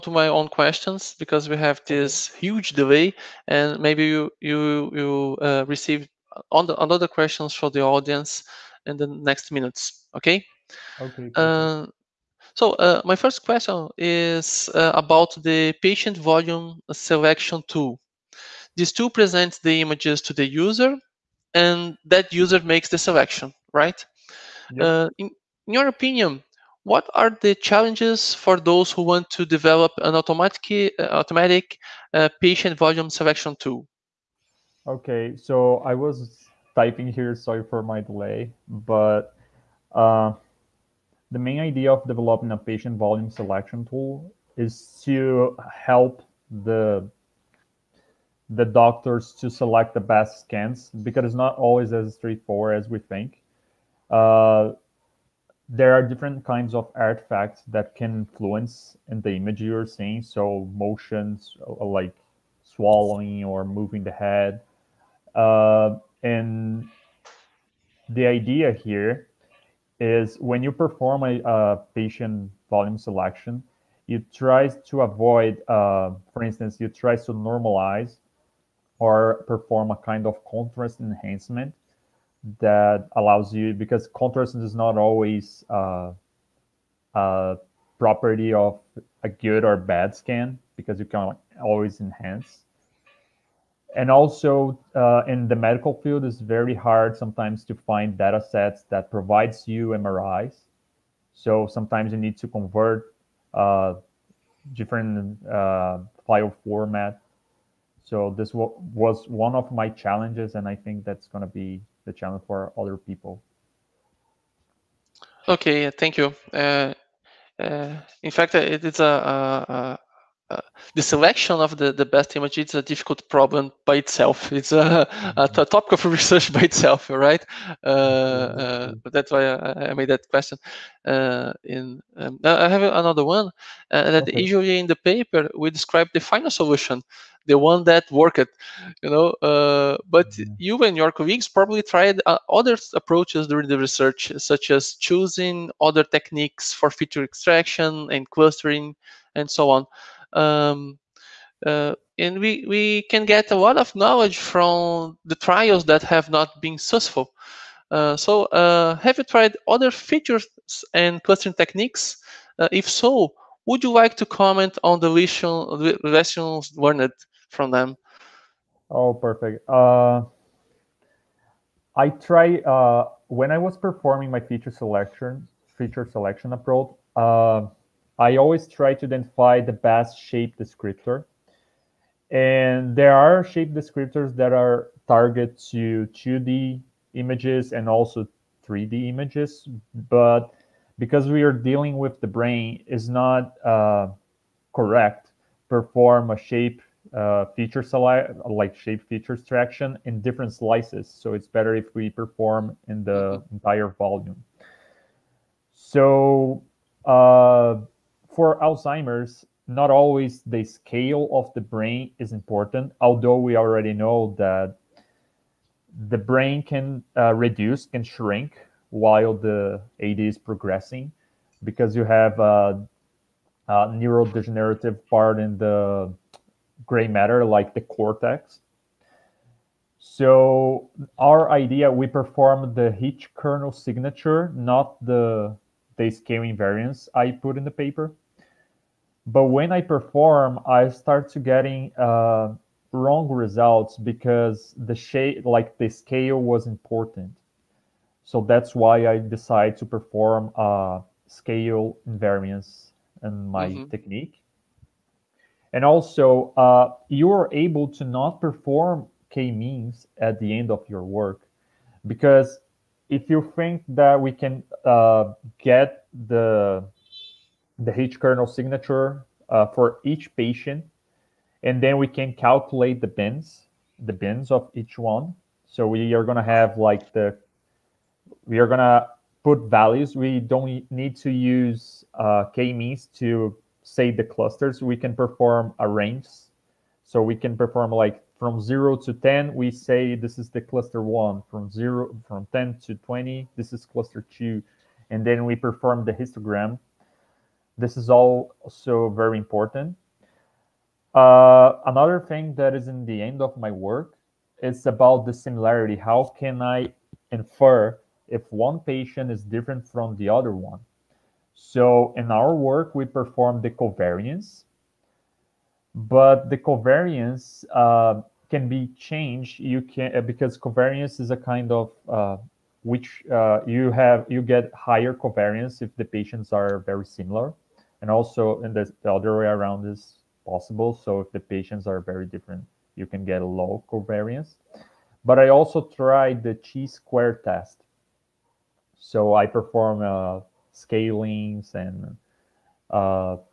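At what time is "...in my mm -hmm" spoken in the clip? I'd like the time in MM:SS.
04:13.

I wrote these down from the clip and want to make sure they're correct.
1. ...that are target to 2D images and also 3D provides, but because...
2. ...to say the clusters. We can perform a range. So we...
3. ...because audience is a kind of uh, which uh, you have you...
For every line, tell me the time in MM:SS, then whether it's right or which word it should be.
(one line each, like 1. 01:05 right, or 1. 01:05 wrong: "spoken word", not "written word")
1. 03:04 wrong: "images", not "provides"
2. 04:43 right
3. 05:20 wrong: "covariance", not "audience".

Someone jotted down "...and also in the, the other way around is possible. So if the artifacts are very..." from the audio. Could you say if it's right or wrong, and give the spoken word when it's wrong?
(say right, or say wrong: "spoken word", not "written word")
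wrong: "patients", not "artifacts".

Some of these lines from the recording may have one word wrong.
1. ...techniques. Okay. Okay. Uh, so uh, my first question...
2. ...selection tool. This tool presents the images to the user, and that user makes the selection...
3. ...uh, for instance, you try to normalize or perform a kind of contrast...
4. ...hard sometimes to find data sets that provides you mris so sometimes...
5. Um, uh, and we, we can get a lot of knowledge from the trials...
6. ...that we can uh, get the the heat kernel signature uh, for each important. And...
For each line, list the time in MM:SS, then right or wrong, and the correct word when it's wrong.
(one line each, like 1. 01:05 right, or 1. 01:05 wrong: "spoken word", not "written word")
1. 00:09 wrong: "minutes", not "techniques"
2. 00:16 right
3. 01:15 right
4. 01:36 right
5. 02:30 right
6. 04:23 wrong: "patient", not "important".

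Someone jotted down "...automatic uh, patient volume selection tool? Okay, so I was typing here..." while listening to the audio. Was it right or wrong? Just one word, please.
right.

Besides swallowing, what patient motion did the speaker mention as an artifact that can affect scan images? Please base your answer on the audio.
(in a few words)
Moving the head.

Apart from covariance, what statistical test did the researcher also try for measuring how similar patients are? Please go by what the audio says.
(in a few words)
Chi square test.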